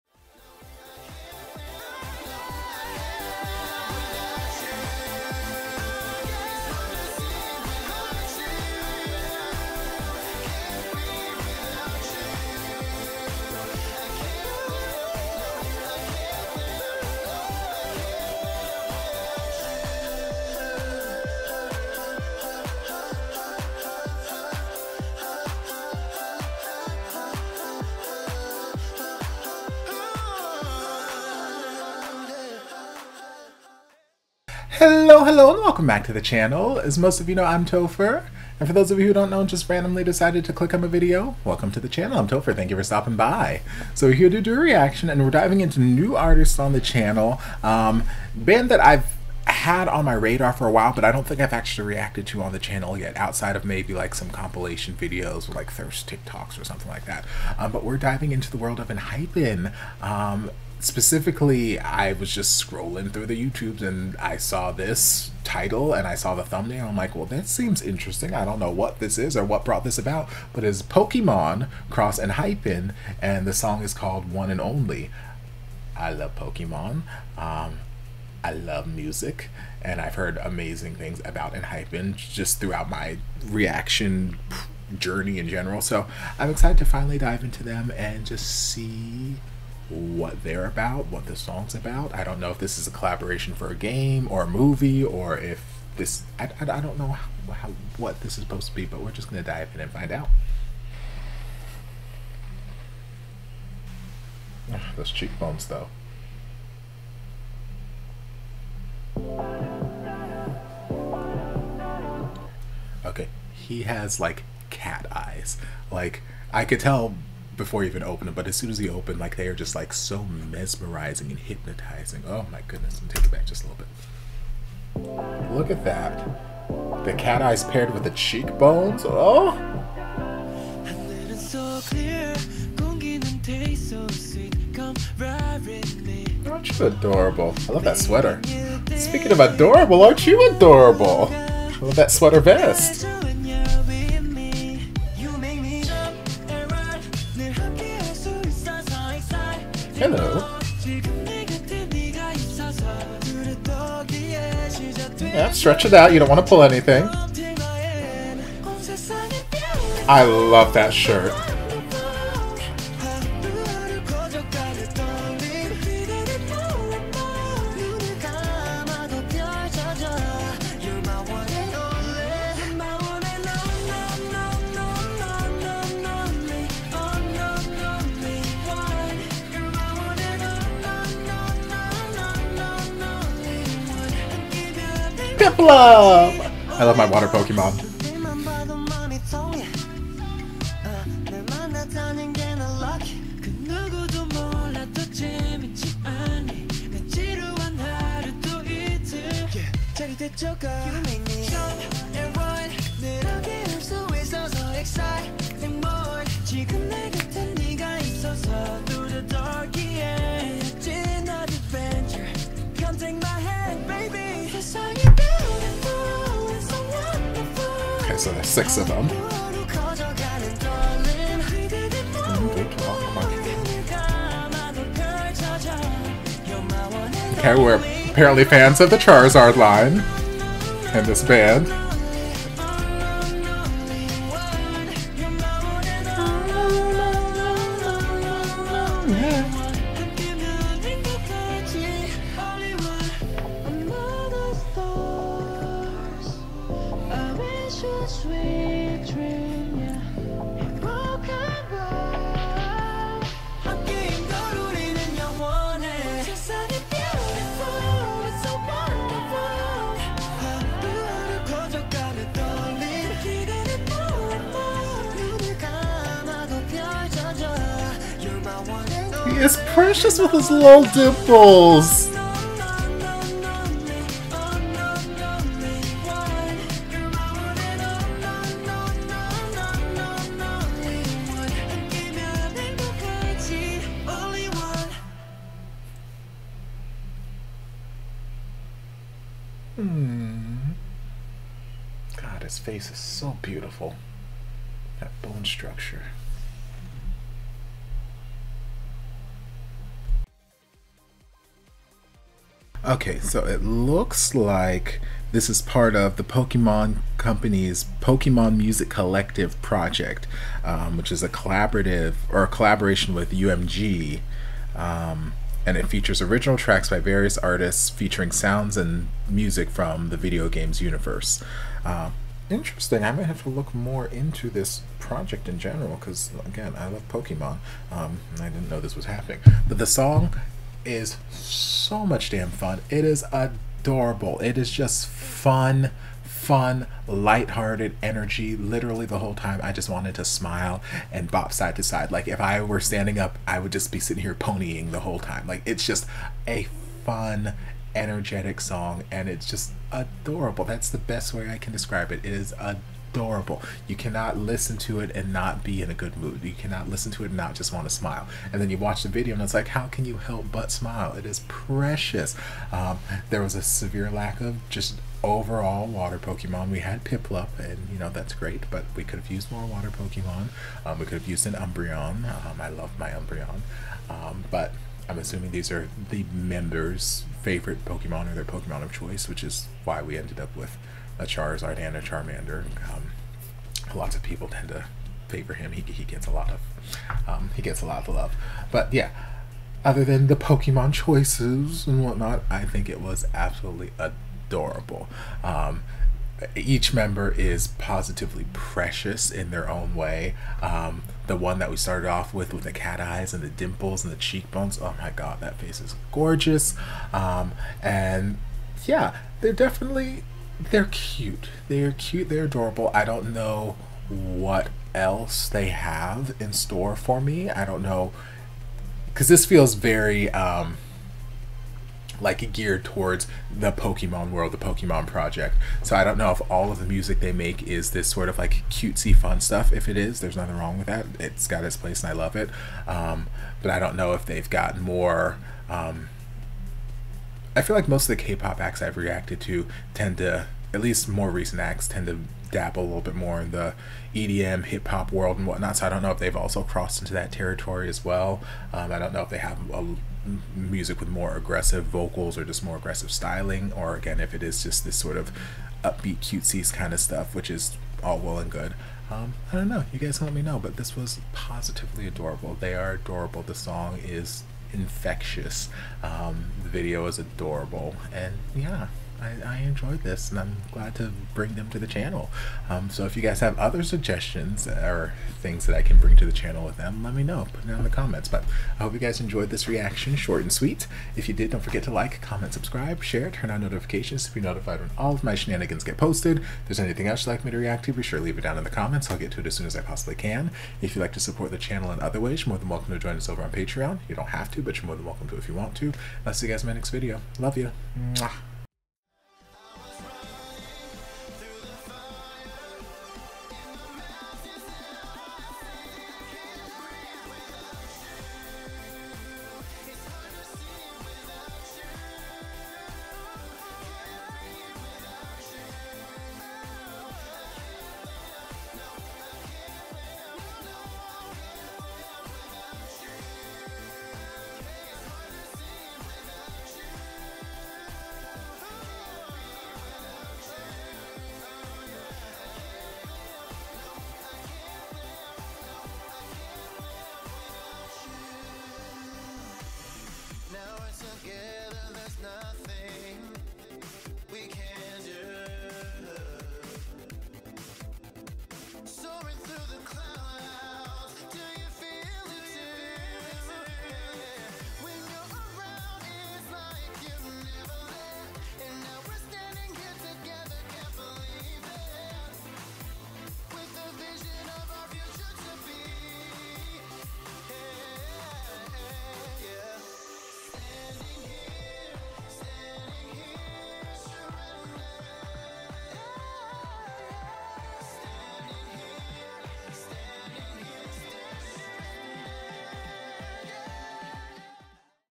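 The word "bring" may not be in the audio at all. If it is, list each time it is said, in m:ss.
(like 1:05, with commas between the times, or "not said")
7:51, 7:55.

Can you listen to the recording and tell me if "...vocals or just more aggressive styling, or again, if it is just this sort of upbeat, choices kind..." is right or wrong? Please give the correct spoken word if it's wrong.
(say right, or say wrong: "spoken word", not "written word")
wrong: "cutesies", not "choices".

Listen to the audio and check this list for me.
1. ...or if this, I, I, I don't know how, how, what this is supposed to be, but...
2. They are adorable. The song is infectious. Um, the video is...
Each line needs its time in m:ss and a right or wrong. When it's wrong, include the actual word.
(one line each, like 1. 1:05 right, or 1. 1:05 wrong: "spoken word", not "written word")
1. 1:35 right
2. 7:42 right.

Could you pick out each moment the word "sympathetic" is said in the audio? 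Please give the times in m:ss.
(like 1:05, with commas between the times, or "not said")
not said.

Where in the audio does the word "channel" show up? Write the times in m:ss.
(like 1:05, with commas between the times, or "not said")
0:36, 0:41, 0:46, 0:52, 7:51, 7:56, 8:11.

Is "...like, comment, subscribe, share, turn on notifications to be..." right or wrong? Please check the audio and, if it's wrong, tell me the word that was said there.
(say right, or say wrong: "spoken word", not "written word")
right.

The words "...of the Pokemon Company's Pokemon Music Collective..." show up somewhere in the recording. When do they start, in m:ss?
5:05.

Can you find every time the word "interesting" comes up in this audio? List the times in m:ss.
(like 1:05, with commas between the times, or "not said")
1:07, 5:22.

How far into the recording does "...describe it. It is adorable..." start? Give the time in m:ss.
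5:51.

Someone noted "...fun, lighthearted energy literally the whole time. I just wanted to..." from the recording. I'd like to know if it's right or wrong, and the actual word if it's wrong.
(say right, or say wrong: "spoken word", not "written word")
right.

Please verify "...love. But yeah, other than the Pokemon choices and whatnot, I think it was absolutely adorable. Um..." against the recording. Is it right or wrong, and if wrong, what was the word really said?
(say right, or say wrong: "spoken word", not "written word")
right.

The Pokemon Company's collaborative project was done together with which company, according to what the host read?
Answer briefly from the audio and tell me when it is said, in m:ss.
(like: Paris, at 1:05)
UMG, at 5:13.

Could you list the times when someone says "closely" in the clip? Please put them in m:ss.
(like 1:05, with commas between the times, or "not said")
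not said.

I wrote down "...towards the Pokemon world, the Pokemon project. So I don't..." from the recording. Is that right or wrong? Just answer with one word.
right.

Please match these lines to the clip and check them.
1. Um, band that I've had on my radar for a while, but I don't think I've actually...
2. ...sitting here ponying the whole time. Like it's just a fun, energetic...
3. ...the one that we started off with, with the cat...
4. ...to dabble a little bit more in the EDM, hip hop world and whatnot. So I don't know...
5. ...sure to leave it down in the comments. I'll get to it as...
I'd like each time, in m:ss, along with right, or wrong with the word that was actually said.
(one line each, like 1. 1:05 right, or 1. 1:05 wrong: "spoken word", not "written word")
1. 0:47 right
2. 5:43 right
3. 6:41 right
4. 7:22 right
5. 8:08 right.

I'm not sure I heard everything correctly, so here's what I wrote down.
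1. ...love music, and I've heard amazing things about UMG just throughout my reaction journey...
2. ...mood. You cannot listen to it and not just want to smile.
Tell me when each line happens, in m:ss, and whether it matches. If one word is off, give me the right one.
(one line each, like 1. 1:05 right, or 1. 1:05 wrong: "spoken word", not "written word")
1. 1:18 wrong: "Enhypen", not "UMG"
2. 5:56 right.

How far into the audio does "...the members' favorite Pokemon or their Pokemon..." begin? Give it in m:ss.
6:16.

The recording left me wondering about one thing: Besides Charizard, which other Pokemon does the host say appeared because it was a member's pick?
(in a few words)
Charmander.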